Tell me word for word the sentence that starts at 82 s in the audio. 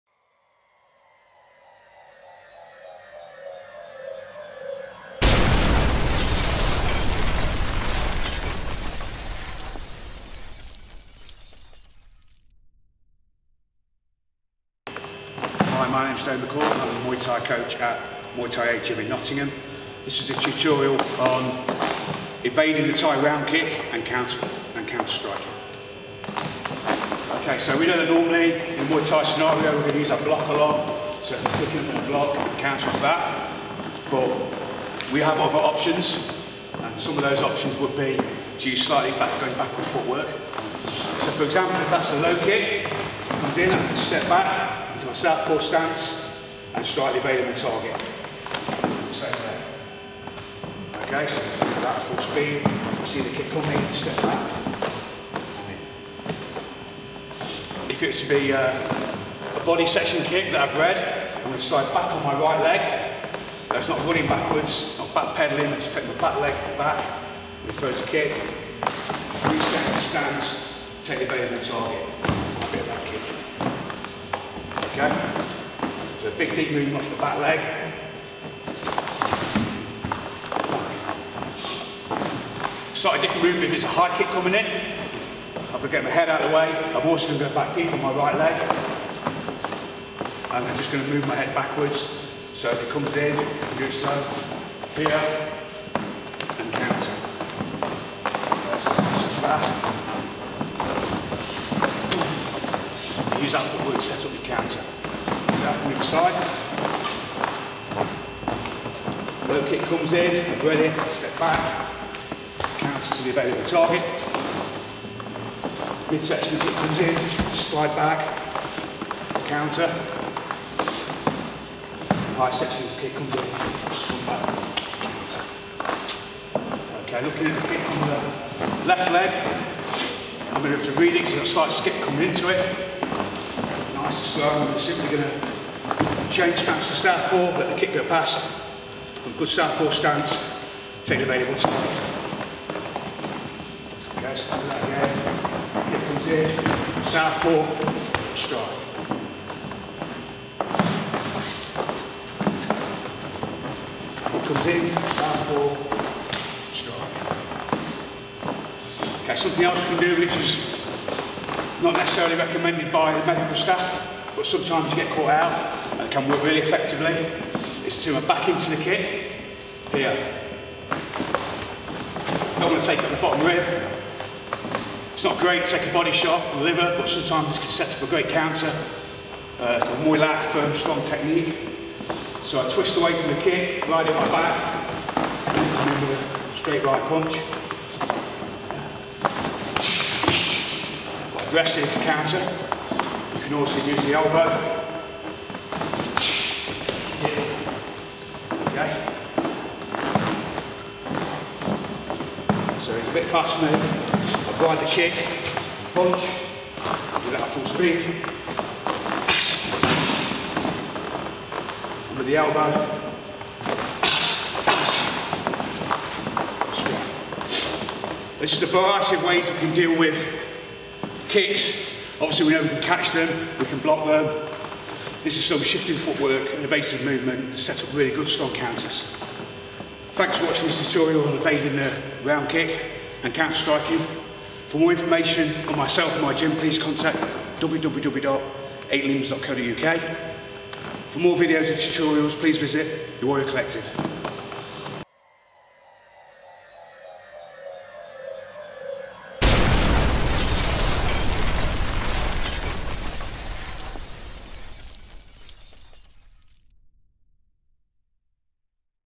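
Slightly different movement if a high kick coming in.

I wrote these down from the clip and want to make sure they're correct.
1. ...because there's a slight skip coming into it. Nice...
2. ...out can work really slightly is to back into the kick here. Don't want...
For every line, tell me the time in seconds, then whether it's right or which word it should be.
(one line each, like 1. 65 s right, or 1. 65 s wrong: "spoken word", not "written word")
1. 131 s right
2. 165 s wrong: "effectively", not "slightly".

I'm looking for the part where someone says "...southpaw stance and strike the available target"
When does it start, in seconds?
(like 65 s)
45 s.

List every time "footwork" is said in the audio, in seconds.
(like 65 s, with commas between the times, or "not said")
39 s, 103 s, 225 s.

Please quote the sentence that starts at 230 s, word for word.
Thanks for watching this tutorial on evading the round kick and counter striking.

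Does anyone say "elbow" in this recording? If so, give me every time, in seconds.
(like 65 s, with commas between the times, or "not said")
194 s, 212 s.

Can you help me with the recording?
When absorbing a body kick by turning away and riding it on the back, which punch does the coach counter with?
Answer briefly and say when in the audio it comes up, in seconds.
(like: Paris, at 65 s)
straight right punch, at 186 s.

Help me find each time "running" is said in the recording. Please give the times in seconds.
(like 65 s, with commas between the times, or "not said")
64 s.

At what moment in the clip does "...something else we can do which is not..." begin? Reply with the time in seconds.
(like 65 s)
159 s.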